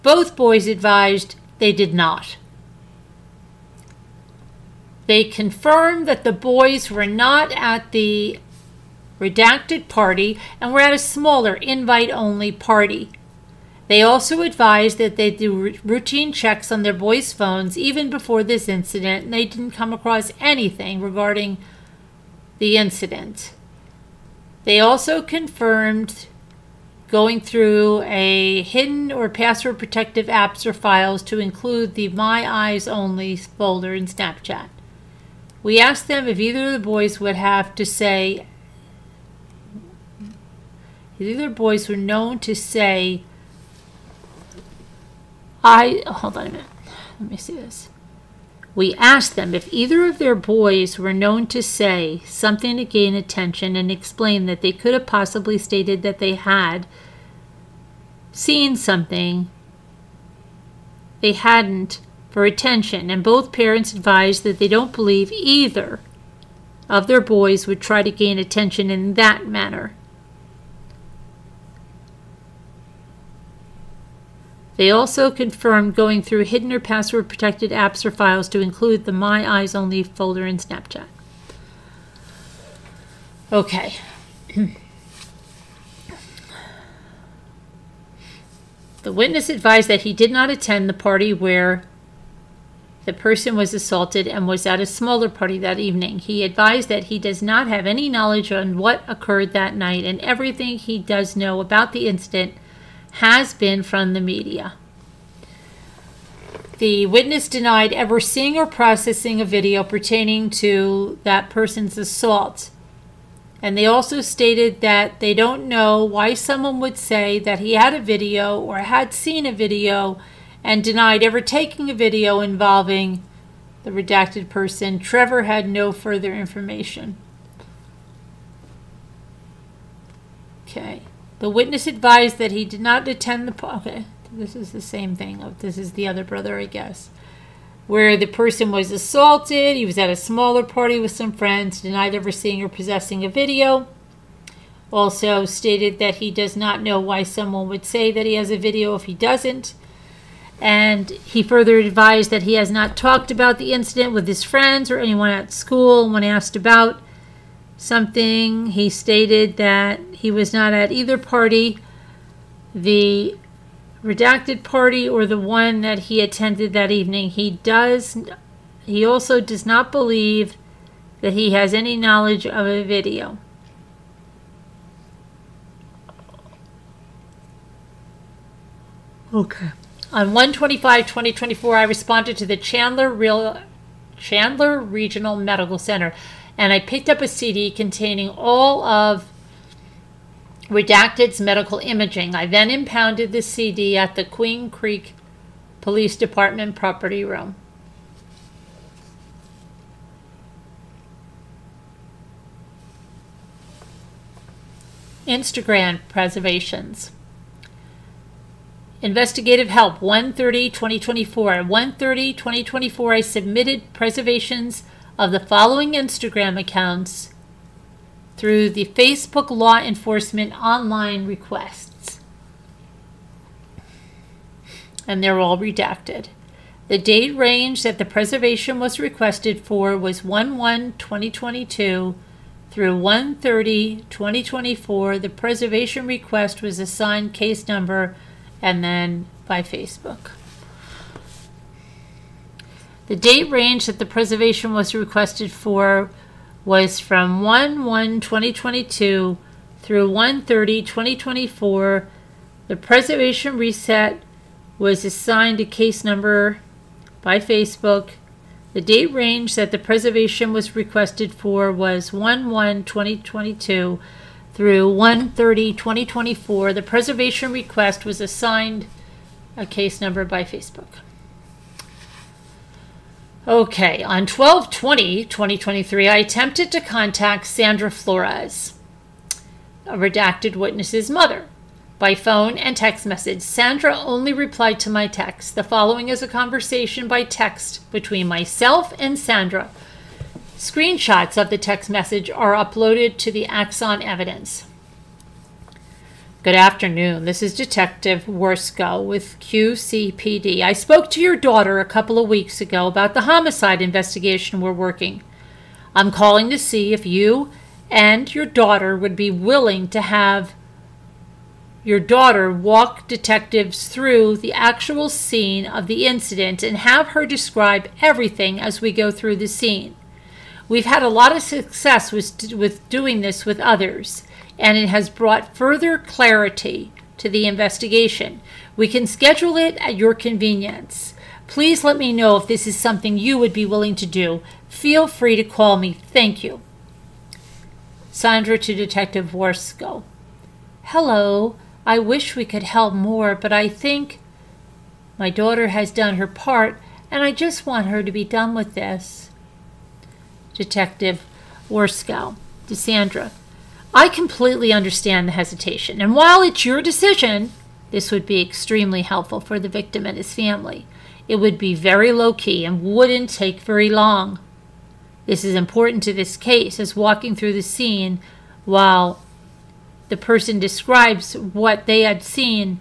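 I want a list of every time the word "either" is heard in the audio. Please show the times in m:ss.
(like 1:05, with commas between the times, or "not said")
0:36, 0:49, 1:05, 2:40.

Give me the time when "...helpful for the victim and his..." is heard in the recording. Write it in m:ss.
5:59.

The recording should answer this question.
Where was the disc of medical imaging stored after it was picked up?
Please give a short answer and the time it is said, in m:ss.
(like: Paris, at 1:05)
Queen Creek Police Department property room, at 3:14.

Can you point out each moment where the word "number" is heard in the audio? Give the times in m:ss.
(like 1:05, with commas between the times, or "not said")
3:57, 4:16, 4:29.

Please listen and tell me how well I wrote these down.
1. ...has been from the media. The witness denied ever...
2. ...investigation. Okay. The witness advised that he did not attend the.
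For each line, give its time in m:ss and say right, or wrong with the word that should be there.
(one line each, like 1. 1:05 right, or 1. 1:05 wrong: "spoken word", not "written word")
1. 1:43 right
2. 2:06 wrong: "information", not "investigation".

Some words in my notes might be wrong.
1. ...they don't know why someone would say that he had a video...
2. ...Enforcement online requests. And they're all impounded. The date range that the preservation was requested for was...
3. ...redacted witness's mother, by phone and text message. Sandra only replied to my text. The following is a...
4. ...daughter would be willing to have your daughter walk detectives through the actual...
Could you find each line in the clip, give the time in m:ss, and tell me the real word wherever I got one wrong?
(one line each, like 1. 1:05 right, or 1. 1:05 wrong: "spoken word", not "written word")
1. 1:55 right
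2. 3:39 wrong: "redacted", not "impounded"
3. 4:39 right
4. 5:08 right.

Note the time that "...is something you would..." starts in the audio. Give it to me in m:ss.
5:32.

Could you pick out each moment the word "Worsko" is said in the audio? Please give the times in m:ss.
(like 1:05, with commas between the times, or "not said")
4:58, 5:39, 5:51.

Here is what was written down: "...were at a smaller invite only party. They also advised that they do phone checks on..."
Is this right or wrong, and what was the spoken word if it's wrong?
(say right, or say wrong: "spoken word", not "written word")
wrong: "routine", not "phone".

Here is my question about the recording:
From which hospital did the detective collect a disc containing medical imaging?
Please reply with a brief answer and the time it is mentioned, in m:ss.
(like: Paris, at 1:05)
Chandler Regional Medical Center, at 3:04.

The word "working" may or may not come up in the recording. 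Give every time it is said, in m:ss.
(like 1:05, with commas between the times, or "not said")
5:04.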